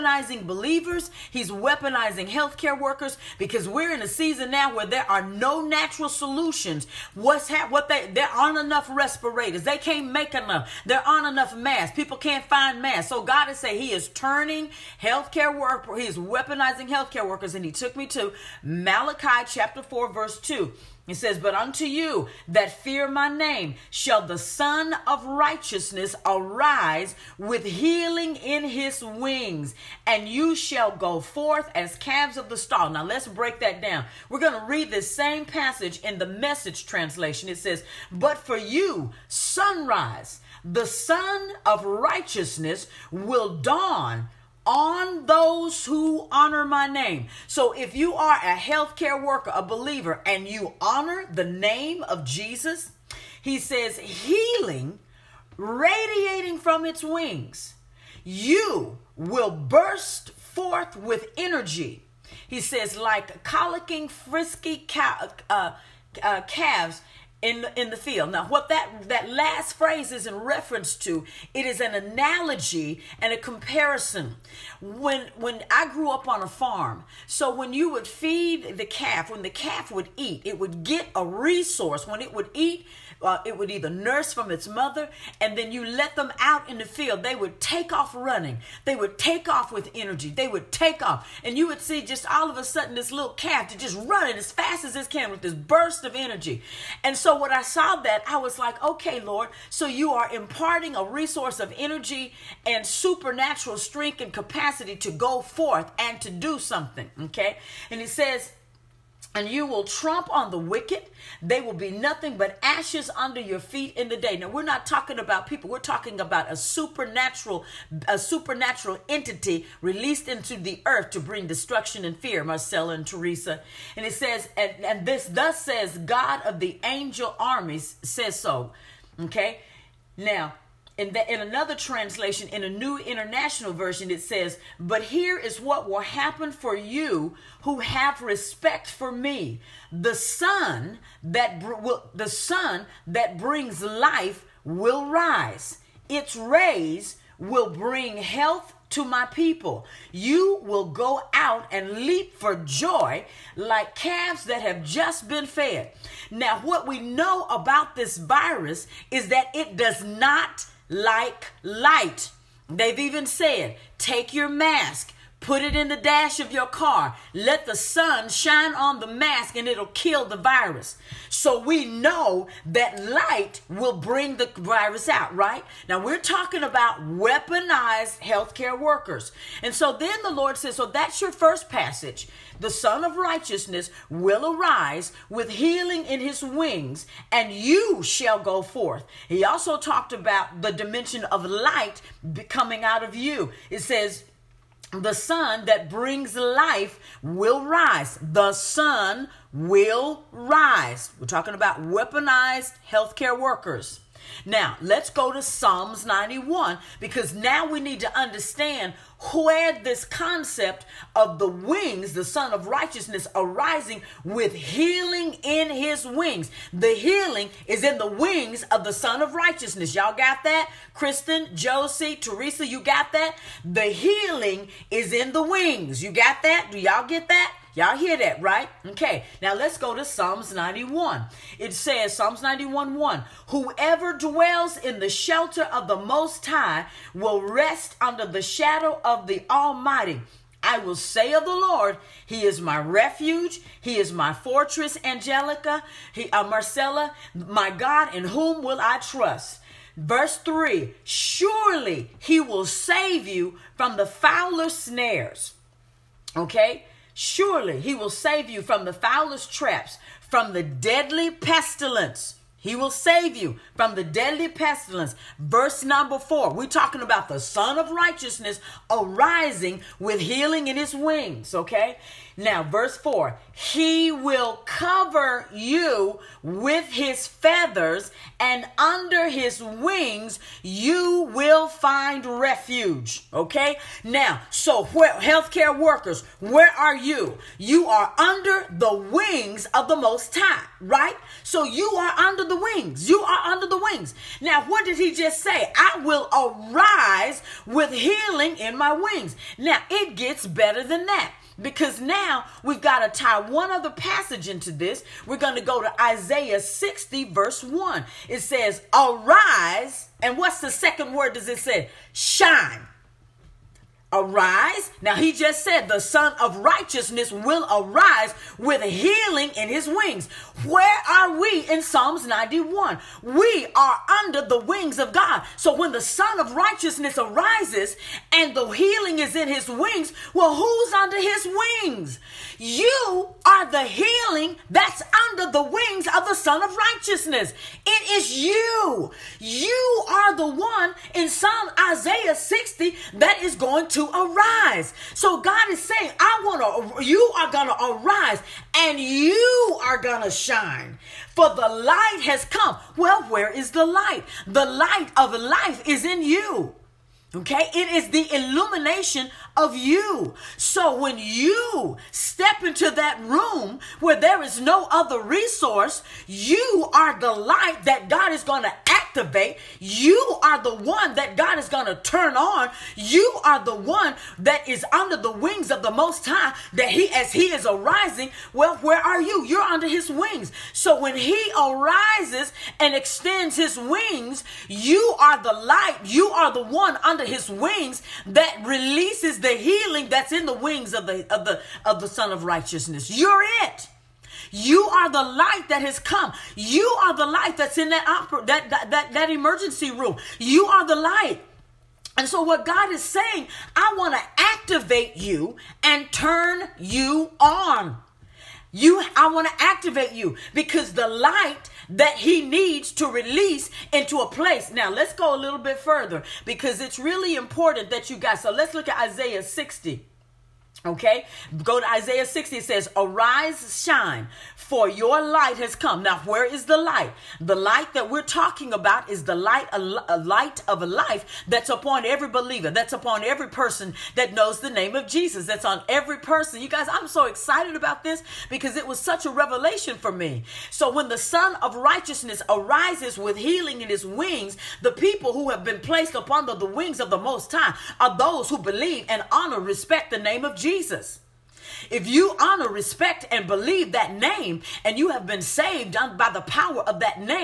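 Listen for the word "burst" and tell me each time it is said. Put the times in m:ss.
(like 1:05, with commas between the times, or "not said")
0:59, 1:35.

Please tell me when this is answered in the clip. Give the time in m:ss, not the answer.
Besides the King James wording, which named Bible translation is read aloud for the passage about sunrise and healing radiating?
0:36.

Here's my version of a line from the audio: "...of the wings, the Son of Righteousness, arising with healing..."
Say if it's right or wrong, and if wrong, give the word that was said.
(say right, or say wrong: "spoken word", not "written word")
right.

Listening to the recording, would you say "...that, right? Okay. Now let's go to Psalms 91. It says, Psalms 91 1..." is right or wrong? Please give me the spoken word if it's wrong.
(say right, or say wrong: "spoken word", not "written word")
right.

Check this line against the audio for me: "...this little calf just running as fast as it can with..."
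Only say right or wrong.
right.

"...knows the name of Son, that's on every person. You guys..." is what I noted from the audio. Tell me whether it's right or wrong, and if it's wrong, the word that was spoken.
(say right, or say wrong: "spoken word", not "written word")
wrong: "Jesus", not "Son".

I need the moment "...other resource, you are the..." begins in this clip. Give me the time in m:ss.
6:04.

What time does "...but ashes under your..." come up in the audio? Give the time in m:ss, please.
1:52.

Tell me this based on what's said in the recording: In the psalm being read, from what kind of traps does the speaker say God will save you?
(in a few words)
Fowler's snares.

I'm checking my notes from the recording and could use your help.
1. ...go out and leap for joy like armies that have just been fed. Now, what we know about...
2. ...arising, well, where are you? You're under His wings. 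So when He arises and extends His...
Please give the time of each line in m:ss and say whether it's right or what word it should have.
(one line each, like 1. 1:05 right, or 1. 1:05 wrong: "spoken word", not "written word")
1. 2:30 wrong: "calves", not "armies"
2. 6:17 right.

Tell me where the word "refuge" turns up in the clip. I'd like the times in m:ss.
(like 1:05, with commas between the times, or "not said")
4:02, 4:42.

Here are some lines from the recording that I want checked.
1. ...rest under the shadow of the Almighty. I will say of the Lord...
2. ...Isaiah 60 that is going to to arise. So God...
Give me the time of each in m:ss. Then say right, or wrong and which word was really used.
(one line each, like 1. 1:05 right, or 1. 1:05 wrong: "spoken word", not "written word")
1. 3:57 right
2. 5:41 right.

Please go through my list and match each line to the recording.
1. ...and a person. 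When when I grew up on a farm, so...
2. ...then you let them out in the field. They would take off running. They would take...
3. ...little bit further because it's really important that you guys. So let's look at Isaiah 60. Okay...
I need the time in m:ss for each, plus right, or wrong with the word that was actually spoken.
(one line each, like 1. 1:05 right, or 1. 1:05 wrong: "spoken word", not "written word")
1. 1:13 wrong: "comparison", not "person"
2. 1:25 right
3. 6:55 right.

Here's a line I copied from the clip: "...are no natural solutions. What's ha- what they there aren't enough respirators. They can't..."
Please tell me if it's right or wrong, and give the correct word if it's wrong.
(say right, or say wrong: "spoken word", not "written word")
right.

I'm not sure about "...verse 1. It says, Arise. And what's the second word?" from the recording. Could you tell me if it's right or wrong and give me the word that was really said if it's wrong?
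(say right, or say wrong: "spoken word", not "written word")
right.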